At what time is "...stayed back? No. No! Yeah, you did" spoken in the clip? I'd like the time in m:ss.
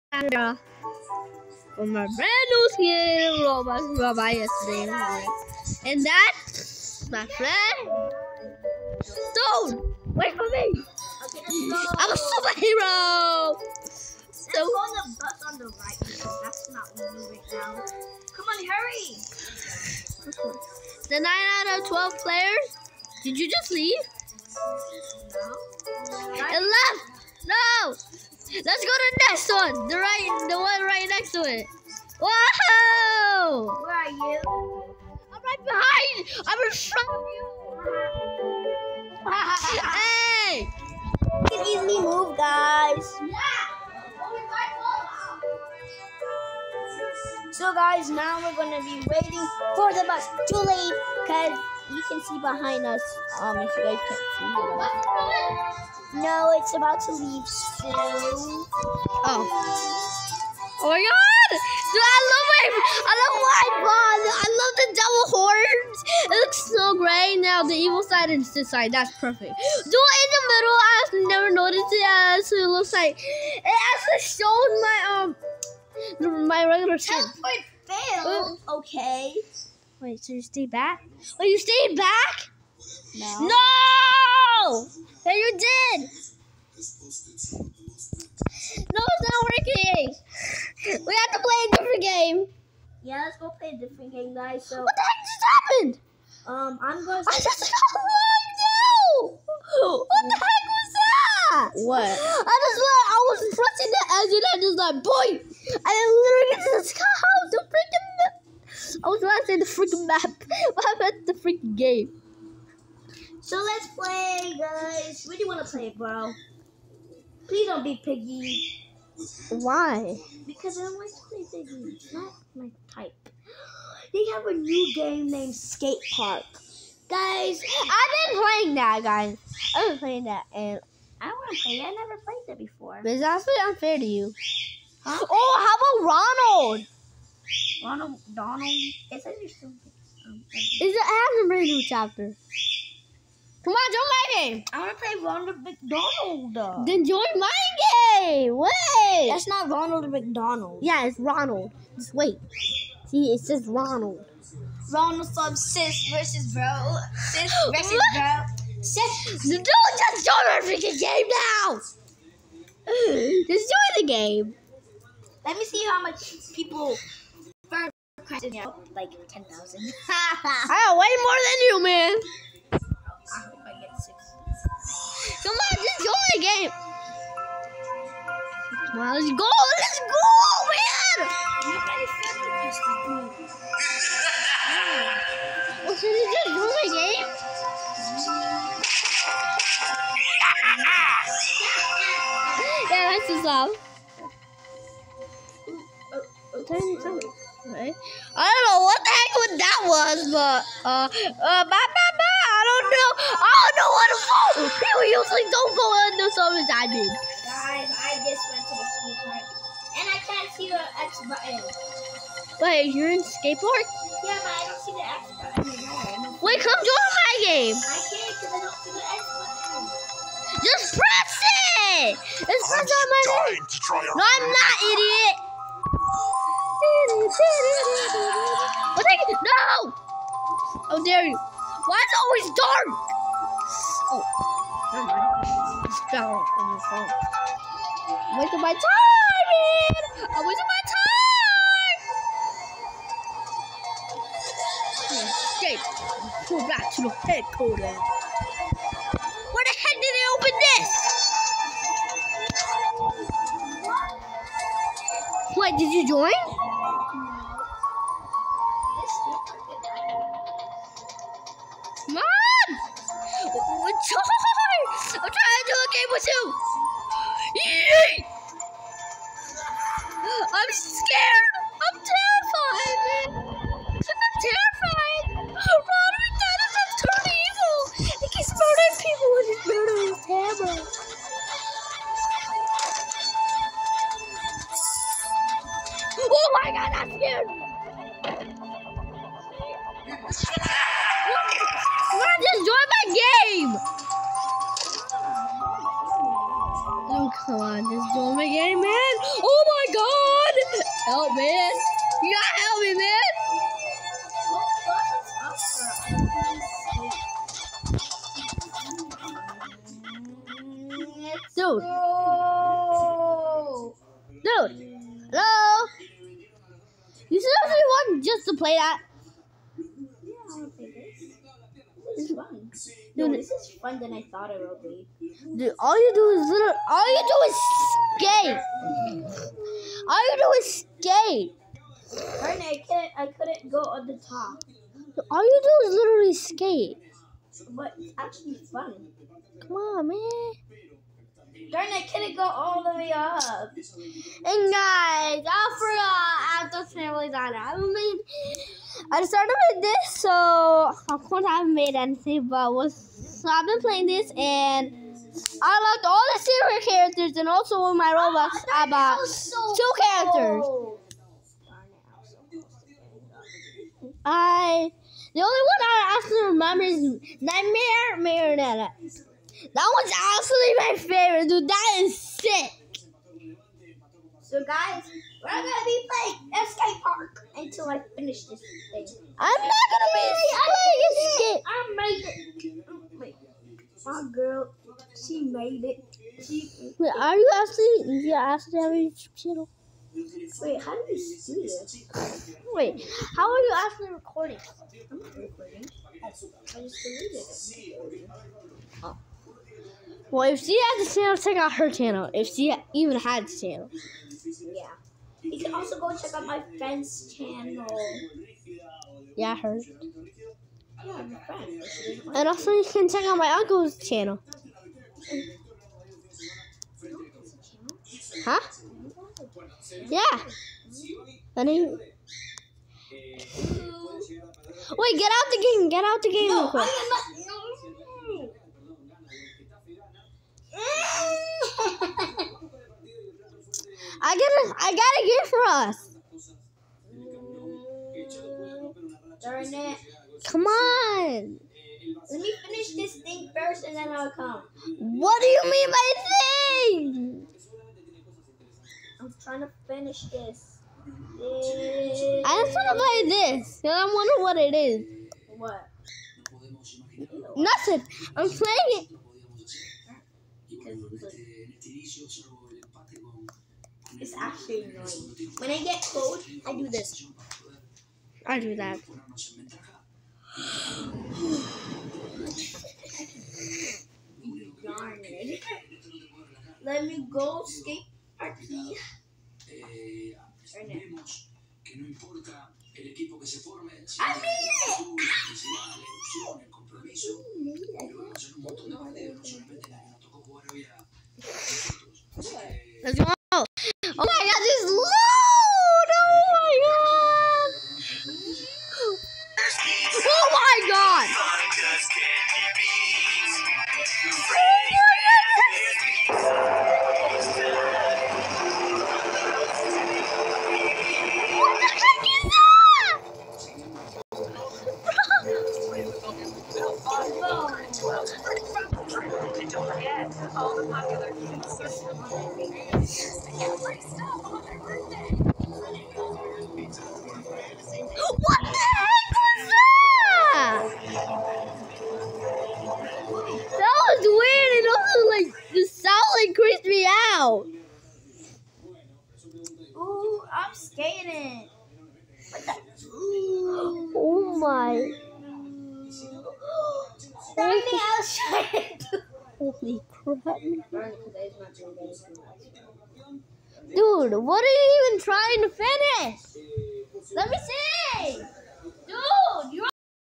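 1:21.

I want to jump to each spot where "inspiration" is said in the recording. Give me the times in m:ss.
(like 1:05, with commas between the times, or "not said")
not said.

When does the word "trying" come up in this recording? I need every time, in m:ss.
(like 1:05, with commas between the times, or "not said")
7:29, 9:15.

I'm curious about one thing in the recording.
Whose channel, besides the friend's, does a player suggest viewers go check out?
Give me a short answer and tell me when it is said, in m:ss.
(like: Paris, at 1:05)
uncle's, at 6:53.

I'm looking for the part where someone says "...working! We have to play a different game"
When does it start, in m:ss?
1:29.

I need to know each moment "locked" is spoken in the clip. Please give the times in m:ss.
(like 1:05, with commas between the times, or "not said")
1:37.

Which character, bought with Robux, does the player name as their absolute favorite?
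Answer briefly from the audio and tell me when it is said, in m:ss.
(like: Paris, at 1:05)
Nightmare Marionette, at 6:07.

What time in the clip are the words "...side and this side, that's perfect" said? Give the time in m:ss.
1:08.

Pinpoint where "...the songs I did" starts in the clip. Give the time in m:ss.
3:26.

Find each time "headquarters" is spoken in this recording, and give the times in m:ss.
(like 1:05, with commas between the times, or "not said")
4:07.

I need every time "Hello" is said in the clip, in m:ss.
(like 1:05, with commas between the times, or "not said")
5:15.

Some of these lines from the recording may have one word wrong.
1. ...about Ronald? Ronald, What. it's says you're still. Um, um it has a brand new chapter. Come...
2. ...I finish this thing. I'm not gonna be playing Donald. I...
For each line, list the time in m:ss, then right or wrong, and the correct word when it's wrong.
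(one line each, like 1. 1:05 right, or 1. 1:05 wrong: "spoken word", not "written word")
1. 2:15 wrong: "Donald", not "What"
2. 6:17 wrong: "Escape", not "Donald".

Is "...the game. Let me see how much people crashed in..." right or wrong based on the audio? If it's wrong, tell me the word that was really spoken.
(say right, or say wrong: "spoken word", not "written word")
right.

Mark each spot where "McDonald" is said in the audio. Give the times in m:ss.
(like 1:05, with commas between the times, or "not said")
2:25, 2:30.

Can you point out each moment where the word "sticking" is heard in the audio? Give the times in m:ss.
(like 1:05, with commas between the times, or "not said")
not said.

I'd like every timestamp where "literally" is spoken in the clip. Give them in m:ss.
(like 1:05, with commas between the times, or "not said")
1:45, 5:35.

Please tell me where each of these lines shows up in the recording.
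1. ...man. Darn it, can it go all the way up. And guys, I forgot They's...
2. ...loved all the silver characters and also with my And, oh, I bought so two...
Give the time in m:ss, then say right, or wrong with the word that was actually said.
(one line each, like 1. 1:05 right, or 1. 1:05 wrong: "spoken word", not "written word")
1. 5:40 wrong: "Adam", not "They"
2. 5:55 wrong: "Robux", not "And".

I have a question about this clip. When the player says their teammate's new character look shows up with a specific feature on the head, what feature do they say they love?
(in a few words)
double horns.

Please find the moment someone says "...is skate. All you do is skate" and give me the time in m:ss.
5:29.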